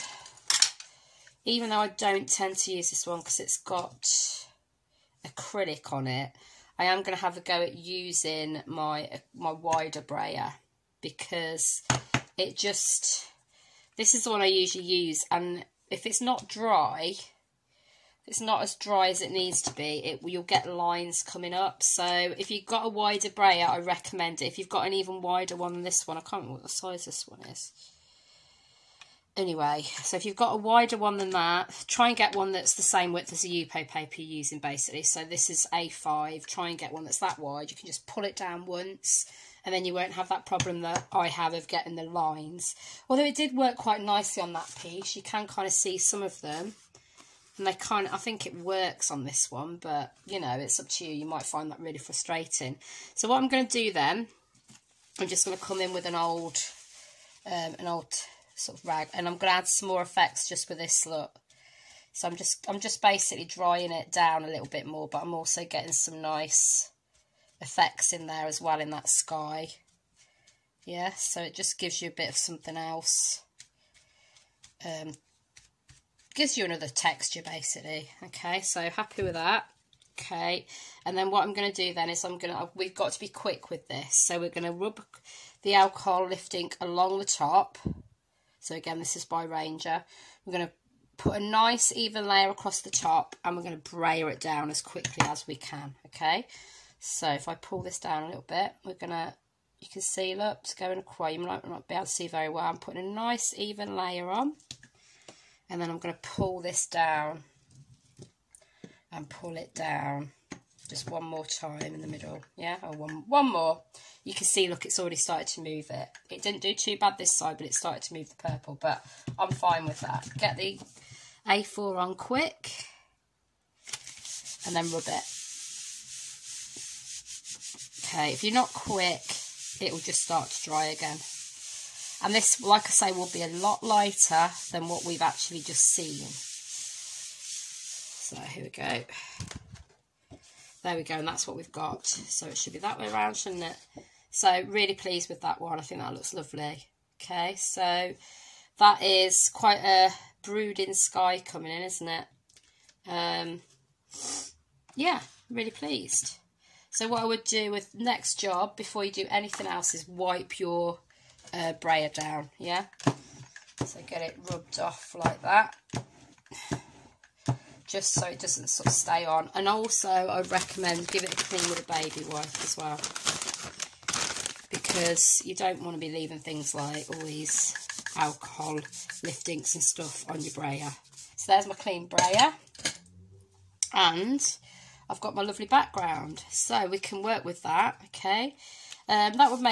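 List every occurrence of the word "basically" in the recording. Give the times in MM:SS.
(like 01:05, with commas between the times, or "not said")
00:34, 01:03, 01:17.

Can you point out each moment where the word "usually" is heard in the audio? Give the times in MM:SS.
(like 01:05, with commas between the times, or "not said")
00:14.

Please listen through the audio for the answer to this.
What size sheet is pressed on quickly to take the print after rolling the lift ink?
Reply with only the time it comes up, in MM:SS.
02:01.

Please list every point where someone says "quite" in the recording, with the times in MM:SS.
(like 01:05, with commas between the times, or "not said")
00:43, 02:29.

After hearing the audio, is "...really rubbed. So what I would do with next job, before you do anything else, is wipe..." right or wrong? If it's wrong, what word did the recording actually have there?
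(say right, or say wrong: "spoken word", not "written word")
wrong: "pleased", not "rubbed".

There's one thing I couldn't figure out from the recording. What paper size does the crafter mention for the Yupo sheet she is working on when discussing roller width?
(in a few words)
A5.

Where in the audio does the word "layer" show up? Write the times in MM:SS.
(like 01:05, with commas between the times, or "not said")
01:32, 01:43.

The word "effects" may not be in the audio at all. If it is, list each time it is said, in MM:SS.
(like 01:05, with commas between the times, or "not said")
01:00, 01:07.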